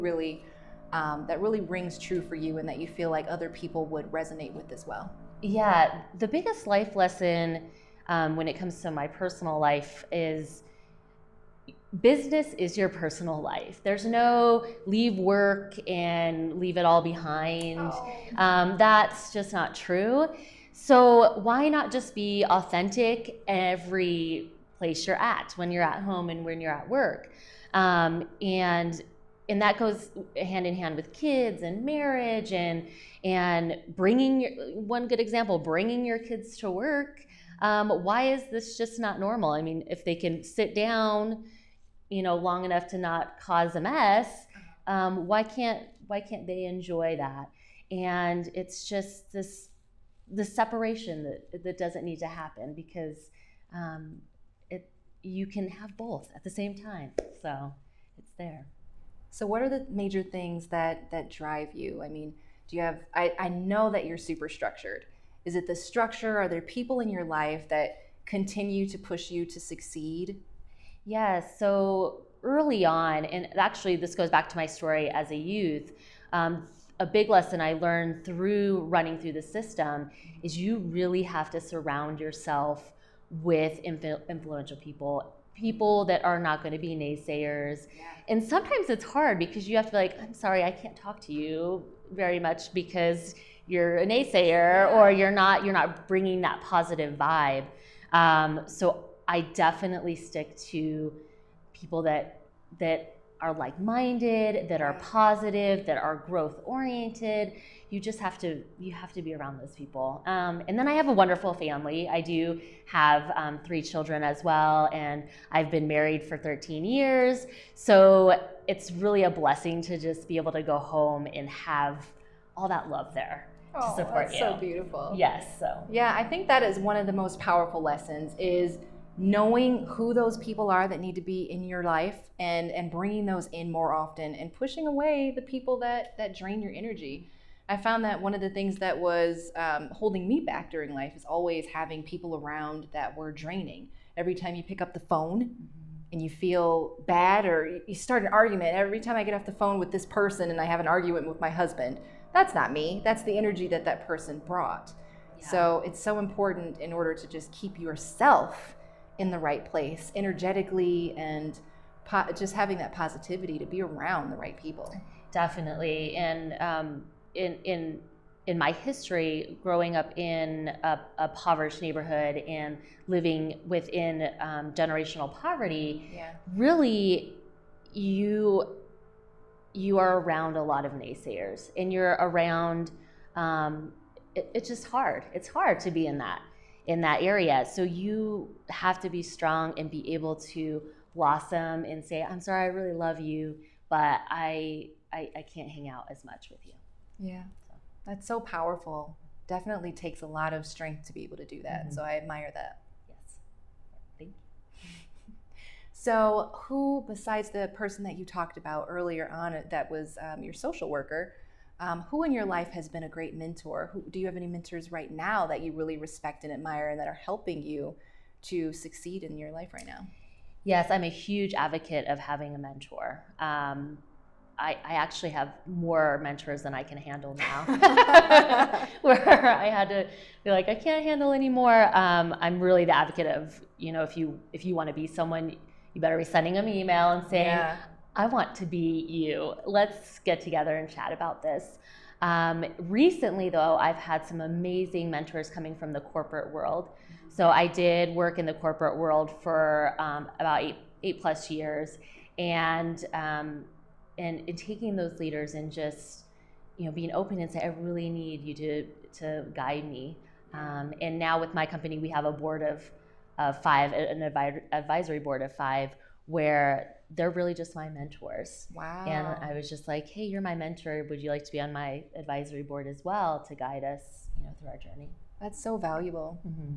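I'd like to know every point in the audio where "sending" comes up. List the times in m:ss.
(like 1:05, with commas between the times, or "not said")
3:56.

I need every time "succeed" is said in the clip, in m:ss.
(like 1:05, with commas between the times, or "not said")
1:09, 3:38.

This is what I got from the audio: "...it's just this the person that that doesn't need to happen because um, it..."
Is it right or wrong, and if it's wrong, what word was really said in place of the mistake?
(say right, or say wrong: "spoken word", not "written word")
wrong: "separation", not "person".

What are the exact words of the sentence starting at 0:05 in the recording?
Yeah, the biggest life lesson um, when it comes to my personal life is business is your personal life.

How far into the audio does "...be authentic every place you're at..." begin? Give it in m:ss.
0:22.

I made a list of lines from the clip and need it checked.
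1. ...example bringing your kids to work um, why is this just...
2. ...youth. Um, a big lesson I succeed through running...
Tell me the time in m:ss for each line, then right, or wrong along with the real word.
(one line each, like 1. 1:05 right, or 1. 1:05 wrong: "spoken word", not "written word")
1. 0:35 right
2. 1:15 wrong: "learned", not "succeed".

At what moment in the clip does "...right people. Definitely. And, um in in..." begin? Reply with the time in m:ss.
2:44.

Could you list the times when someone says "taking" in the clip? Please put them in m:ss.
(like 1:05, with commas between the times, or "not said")
4:14.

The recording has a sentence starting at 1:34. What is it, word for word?
or you're not you're not bringing that positive vibe.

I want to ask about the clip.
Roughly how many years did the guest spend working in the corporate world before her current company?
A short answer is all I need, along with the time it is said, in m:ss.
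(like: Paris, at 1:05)
8, at 4:11.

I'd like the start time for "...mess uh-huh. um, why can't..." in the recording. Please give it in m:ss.
0:43.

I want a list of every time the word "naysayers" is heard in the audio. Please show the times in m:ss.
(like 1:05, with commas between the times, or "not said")
1:26, 1:34, 3:00.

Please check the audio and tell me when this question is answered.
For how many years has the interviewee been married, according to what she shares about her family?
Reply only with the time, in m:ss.
1:56.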